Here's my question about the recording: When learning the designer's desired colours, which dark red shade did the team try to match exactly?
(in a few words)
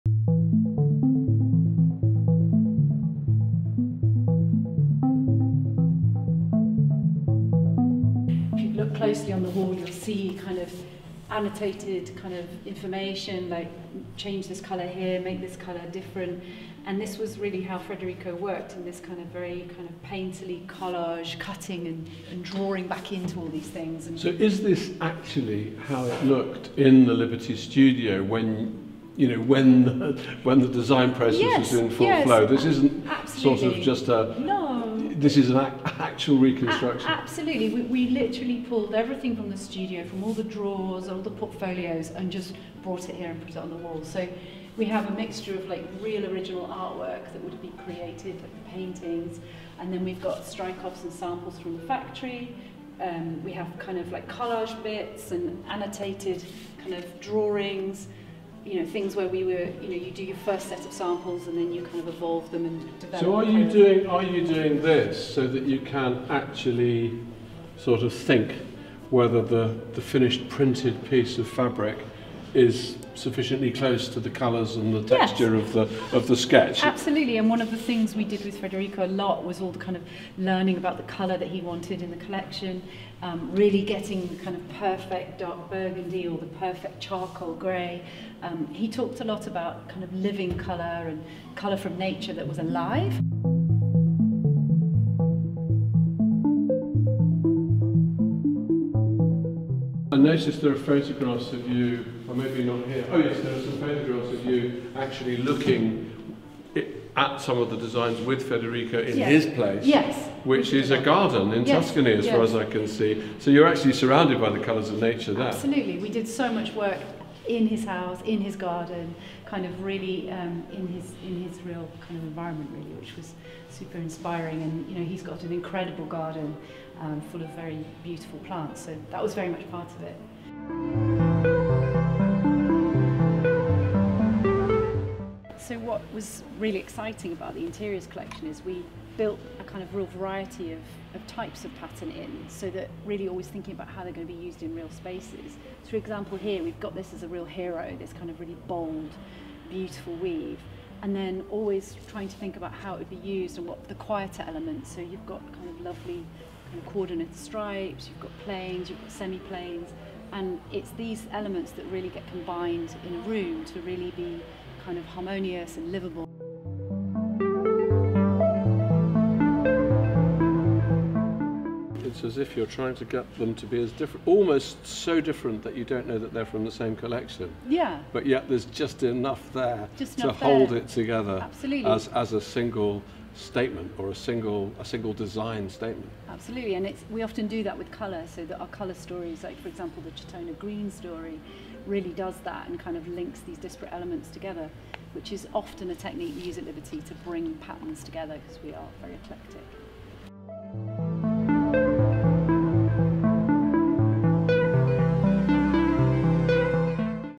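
dark burgundy.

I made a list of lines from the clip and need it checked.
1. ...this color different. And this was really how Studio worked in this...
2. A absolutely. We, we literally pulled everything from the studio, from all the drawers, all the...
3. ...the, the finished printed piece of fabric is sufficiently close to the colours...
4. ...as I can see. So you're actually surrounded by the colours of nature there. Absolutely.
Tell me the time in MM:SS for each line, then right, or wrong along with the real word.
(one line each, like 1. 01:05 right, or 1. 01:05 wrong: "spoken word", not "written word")
1. 00:15 wrong: "Federico", not "Studio"
2. 00:37 right
3. 01:09 right
4. 01:52 right.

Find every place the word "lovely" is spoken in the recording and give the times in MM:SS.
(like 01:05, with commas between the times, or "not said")
02:35.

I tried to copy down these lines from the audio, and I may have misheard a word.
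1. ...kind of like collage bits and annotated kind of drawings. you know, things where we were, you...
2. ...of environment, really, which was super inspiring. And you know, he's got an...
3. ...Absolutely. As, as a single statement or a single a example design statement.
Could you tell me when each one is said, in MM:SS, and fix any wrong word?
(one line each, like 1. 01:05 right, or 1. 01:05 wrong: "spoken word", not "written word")
1. 00:53 right
2. 02:02 right
3. 03:01 wrong: "single", not "example".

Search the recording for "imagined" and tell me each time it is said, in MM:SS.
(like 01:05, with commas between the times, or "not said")
not said.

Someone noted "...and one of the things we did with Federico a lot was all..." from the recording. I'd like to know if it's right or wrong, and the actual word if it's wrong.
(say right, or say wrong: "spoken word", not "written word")
right.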